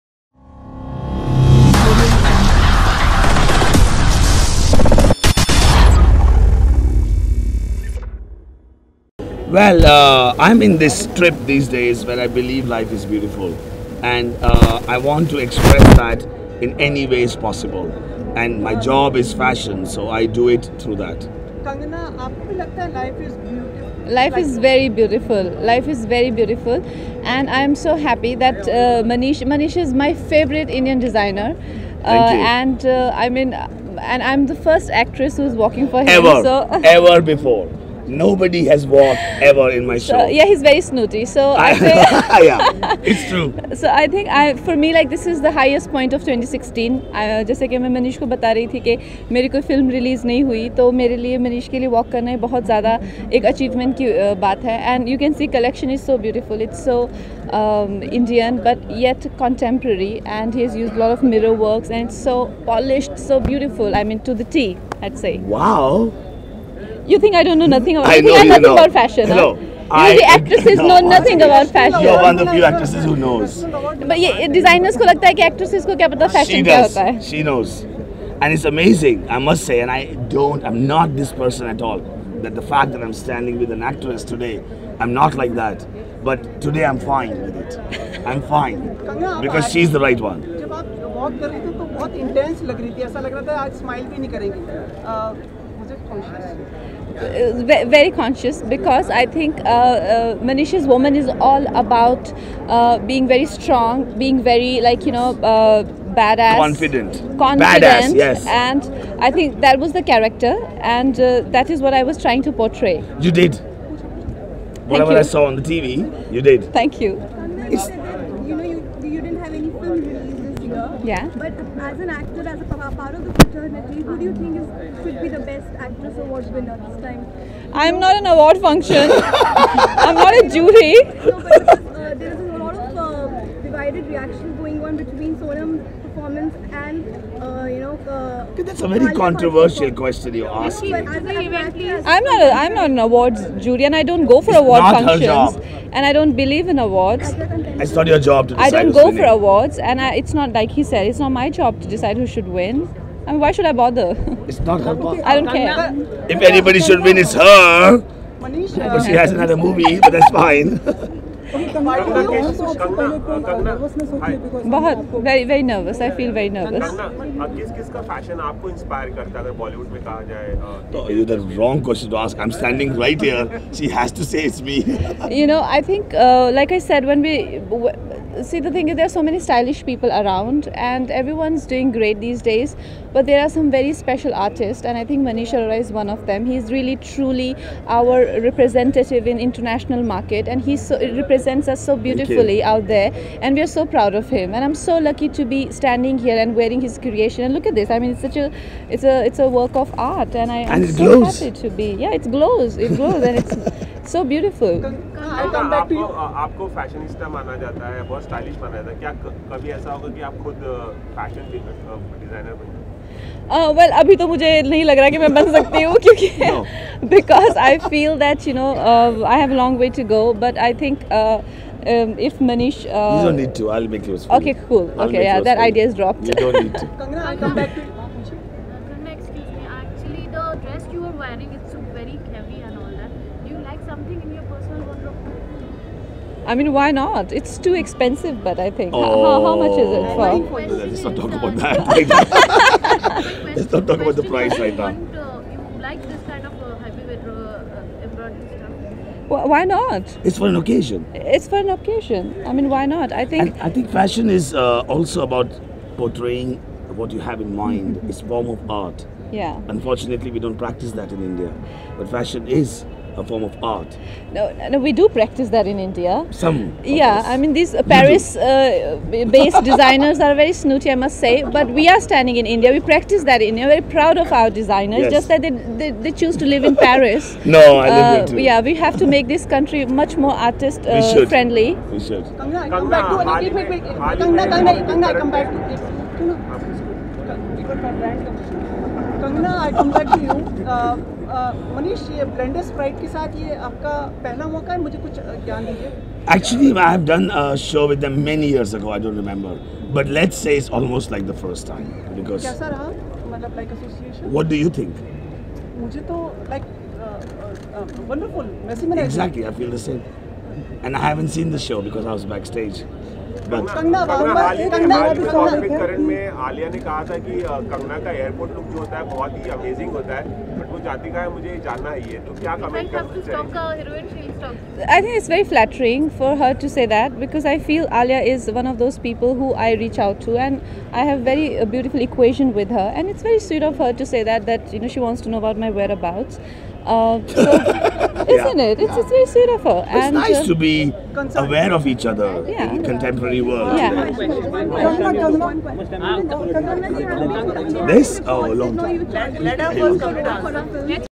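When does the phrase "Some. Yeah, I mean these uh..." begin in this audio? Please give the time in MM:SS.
04:26.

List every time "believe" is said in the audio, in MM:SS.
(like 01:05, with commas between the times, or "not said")
00:12, 02:26.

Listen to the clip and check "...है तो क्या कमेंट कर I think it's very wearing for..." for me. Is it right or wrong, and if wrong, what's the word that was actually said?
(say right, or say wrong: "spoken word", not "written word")
wrong: "flattering", not "wearing".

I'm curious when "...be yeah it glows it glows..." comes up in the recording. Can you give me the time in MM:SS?
03:21.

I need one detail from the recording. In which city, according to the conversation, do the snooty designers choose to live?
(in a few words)
Paris.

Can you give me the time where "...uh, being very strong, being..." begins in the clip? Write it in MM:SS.
01:42.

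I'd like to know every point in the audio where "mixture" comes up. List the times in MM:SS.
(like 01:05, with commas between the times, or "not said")
not said.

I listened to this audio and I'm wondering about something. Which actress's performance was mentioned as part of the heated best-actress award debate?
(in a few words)
Sonam.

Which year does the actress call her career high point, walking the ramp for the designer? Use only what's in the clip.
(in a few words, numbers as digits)
2016.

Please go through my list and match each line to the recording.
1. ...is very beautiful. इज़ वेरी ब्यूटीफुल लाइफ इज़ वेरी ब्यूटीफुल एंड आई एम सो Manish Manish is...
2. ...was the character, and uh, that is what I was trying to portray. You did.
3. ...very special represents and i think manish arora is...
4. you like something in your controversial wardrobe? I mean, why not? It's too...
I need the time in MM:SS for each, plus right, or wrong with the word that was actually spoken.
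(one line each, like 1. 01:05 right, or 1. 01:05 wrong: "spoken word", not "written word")
1. 00:24 right
2. 01:49 right
3. 03:03 wrong: "artists", not "represents"
4. 03:53 wrong: "personal", not "controversial".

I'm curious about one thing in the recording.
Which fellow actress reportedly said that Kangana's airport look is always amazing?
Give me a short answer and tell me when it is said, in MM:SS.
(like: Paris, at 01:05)
Alia, at 05:16.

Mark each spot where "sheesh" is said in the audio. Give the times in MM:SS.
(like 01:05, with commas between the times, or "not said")
not said.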